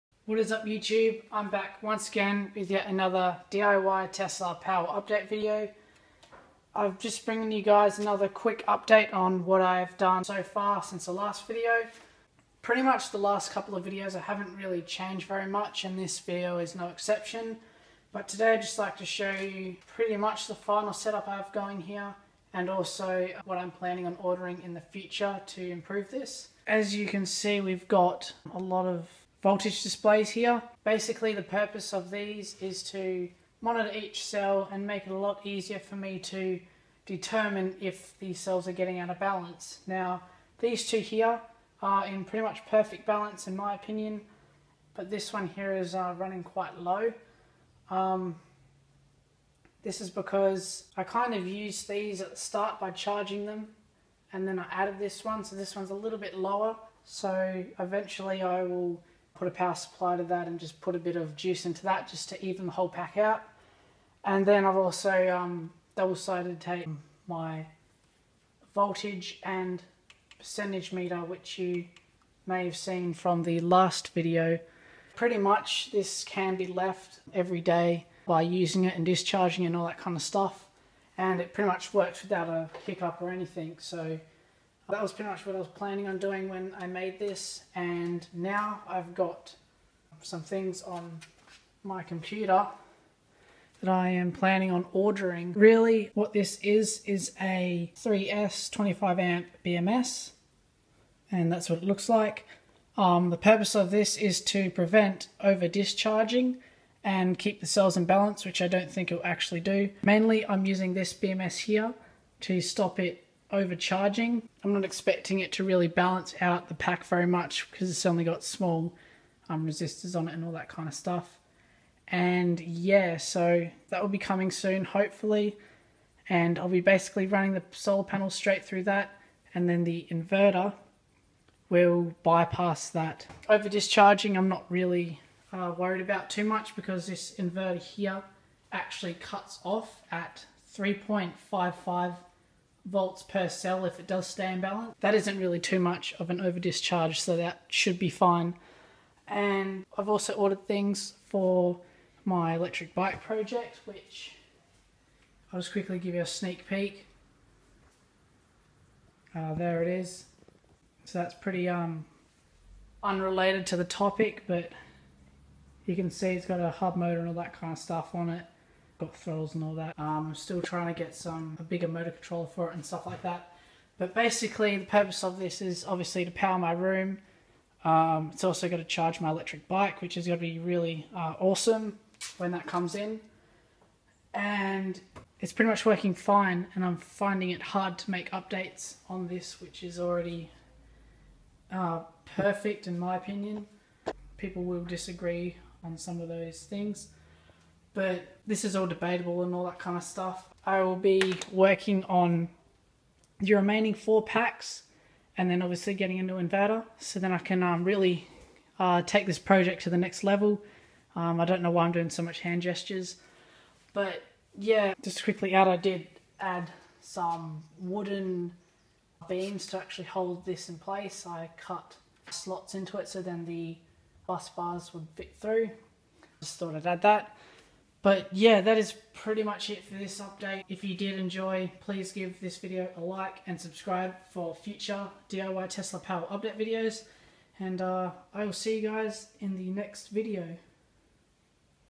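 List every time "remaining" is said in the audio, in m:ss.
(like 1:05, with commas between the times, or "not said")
3:23.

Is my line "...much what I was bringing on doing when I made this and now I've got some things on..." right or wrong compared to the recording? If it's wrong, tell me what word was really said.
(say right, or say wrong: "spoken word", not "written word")
wrong: "planning", not "bringing".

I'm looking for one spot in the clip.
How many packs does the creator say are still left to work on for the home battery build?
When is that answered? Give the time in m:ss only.
3:23.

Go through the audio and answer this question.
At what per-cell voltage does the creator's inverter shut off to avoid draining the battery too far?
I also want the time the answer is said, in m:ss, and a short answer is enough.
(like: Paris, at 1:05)
3.55 volts, at 2:20.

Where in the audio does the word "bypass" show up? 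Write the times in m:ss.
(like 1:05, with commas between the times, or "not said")
2:12.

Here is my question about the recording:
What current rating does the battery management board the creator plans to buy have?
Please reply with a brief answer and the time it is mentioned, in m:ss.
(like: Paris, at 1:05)
25 amps, at 1:38.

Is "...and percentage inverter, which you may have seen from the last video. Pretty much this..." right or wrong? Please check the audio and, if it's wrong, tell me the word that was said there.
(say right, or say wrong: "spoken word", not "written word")
wrong: "meter", not "inverter".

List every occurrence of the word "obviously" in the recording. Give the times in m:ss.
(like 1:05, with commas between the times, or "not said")
2:55, 3:25.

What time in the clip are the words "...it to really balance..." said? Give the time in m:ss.
1:55.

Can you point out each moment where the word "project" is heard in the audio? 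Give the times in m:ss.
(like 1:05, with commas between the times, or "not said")
2:33, 3:29.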